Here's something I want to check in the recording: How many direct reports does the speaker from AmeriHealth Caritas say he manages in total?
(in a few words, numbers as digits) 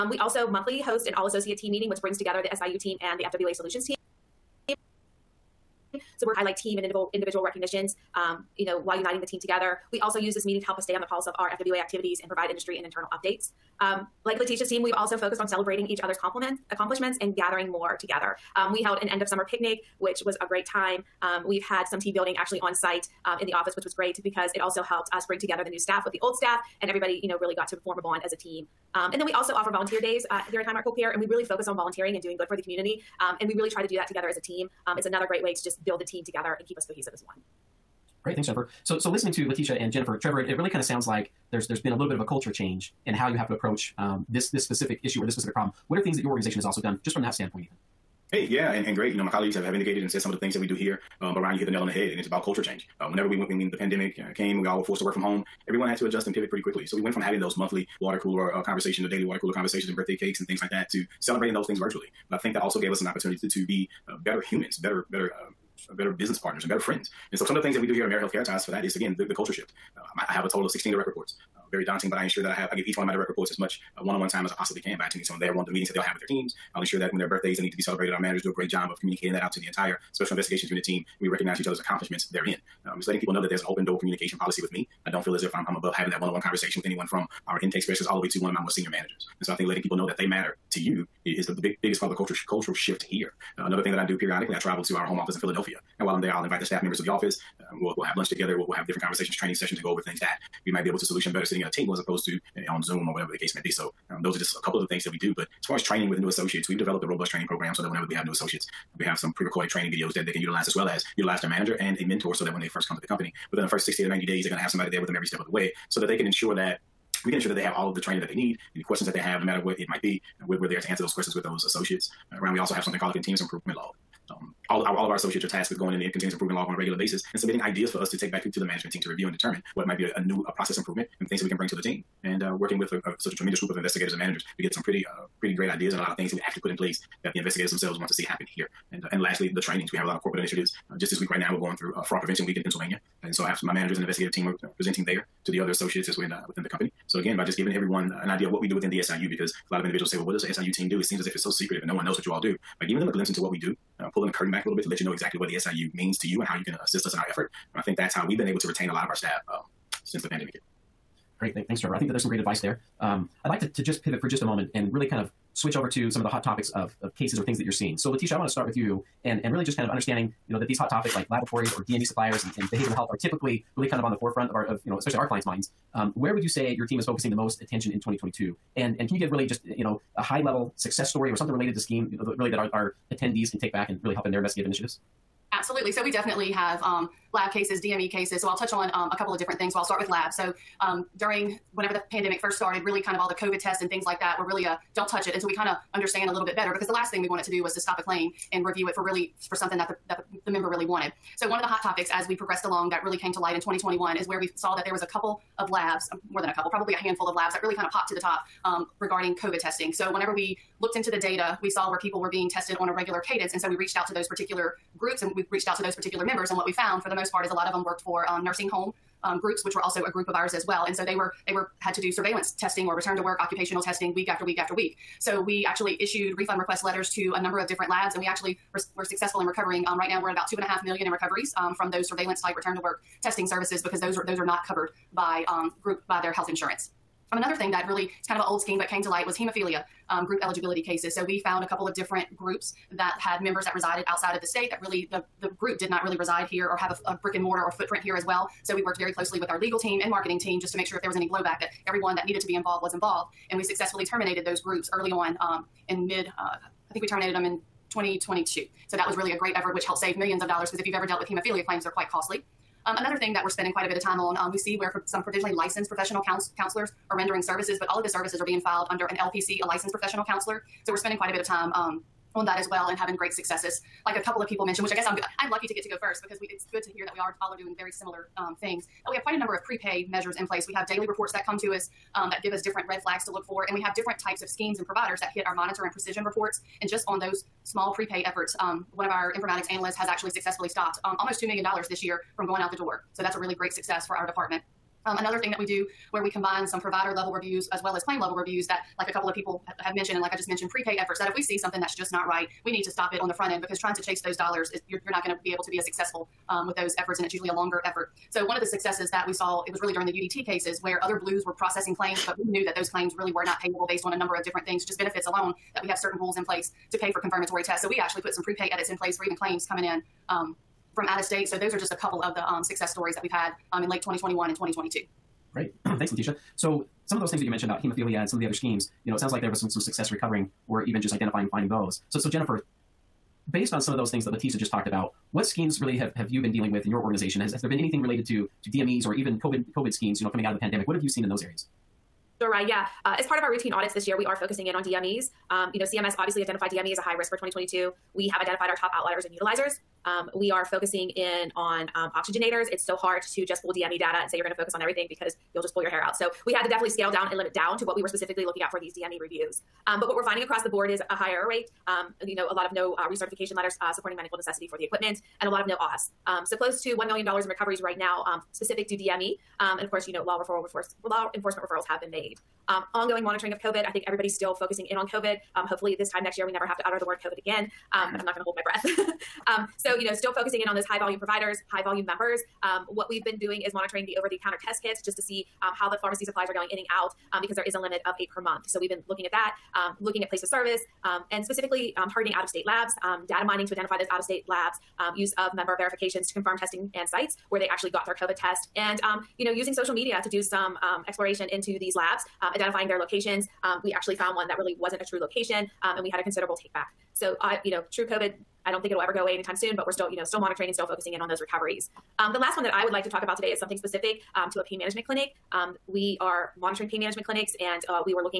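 16.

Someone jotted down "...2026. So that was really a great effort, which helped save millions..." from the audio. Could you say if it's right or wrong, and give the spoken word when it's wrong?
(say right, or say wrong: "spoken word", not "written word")
wrong: "2022", not "2026".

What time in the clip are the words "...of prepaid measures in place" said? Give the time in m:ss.
4:39.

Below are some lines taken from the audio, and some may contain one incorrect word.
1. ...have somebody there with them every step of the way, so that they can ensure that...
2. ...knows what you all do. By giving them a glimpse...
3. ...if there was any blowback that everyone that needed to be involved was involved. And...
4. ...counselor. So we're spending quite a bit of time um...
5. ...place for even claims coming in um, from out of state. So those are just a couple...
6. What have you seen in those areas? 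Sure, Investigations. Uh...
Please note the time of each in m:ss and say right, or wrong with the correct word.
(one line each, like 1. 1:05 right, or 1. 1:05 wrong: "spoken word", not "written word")
1. 1:54 right
2. 2:32 right
3. 4:10 right
4. 4:30 right
5. 5:18 right
6. 5:40 wrong: "Yeah", not "Investigations".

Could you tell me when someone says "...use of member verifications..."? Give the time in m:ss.
6:35.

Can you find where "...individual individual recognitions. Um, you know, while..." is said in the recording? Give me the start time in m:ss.
0:06.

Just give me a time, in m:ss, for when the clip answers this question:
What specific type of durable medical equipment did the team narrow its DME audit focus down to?
5:52.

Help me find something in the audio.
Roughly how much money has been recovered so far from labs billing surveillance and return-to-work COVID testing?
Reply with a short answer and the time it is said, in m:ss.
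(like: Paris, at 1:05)
2.5 million, at 3:50.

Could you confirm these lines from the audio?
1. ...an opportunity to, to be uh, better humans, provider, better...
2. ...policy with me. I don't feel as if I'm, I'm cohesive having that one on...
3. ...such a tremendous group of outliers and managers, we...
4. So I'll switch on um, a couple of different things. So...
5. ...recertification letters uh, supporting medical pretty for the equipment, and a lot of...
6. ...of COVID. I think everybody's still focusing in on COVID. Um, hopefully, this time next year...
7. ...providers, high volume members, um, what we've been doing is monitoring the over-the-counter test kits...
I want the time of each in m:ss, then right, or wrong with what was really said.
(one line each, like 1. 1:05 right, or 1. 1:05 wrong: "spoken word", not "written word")
1. 1:03 wrong: "better", not "provider"
2. 1:24 wrong: "above", not "cohesive"
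3. 2:13 wrong: "investigators", not "outliers"
4. 3:08 wrong: "touch", not "switch"
5. 6:03 wrong: "necessity", not "pretty"
6. 6:13 right
7. 6:21 right.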